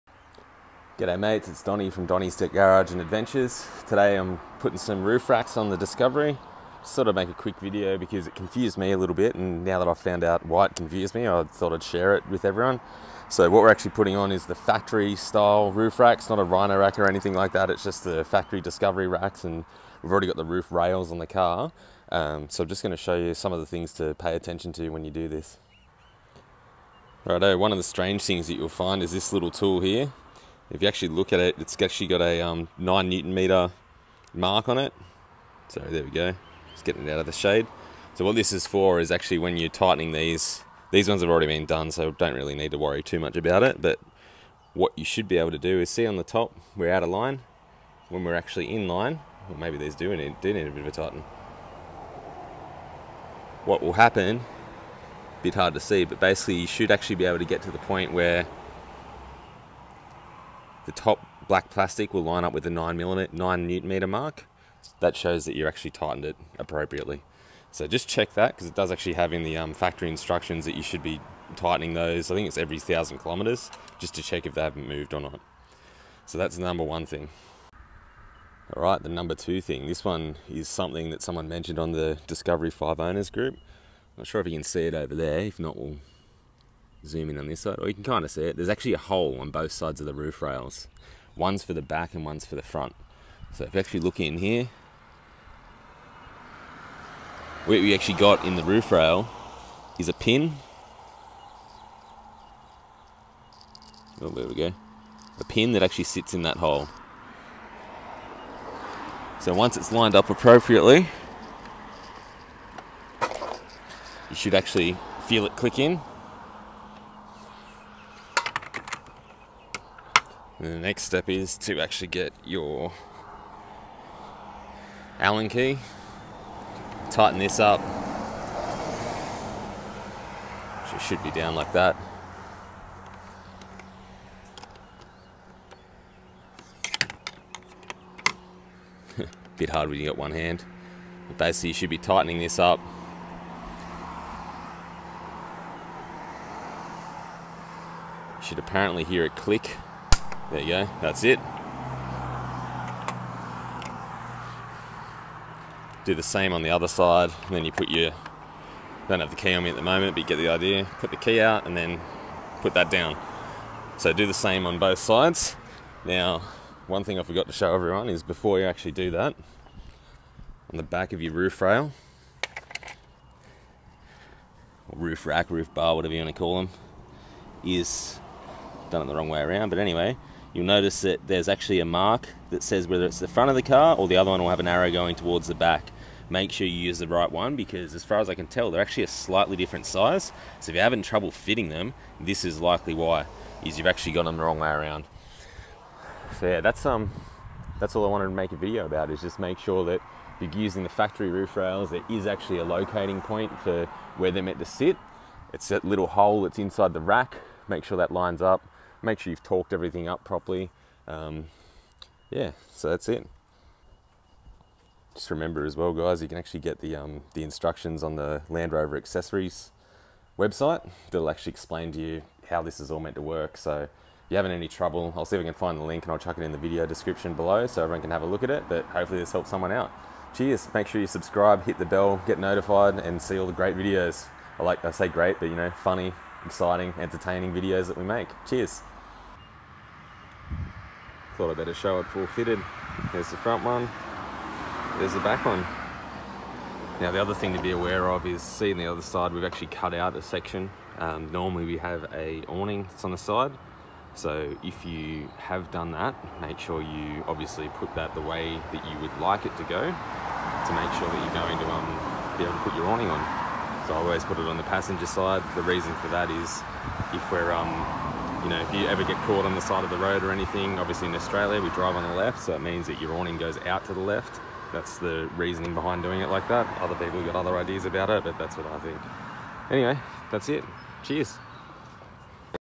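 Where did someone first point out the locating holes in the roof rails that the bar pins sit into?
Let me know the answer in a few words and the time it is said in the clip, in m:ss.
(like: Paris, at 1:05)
Discovery 5 owners group, at 1:22.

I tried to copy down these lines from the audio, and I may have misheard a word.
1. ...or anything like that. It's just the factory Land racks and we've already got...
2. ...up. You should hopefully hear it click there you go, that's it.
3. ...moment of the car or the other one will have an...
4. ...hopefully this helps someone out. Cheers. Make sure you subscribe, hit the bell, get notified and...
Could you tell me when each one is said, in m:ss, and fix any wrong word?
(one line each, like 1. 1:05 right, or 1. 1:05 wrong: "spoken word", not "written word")
1. 0:16 wrong: "Discovery", not "Land"
2. 2:22 wrong: "apparently", not "hopefully"
3. 3:03 wrong: "front", not "moment"
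4. 3:48 right.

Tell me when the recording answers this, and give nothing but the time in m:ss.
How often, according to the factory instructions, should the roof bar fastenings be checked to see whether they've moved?
1:12.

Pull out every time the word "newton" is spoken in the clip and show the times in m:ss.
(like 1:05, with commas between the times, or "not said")
0:33, 1:03.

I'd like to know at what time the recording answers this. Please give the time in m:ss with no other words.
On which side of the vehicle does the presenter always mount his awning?
4:24.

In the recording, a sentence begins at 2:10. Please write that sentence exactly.
It should be down like that.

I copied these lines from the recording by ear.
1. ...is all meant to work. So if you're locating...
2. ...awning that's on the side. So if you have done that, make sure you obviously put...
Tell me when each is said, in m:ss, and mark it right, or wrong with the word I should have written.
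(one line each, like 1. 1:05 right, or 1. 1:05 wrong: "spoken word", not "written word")
1. 3:42 wrong: "having", not "locating"
2. 4:12 right.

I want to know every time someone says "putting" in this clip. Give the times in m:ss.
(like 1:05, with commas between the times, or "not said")
0:04, 0:13.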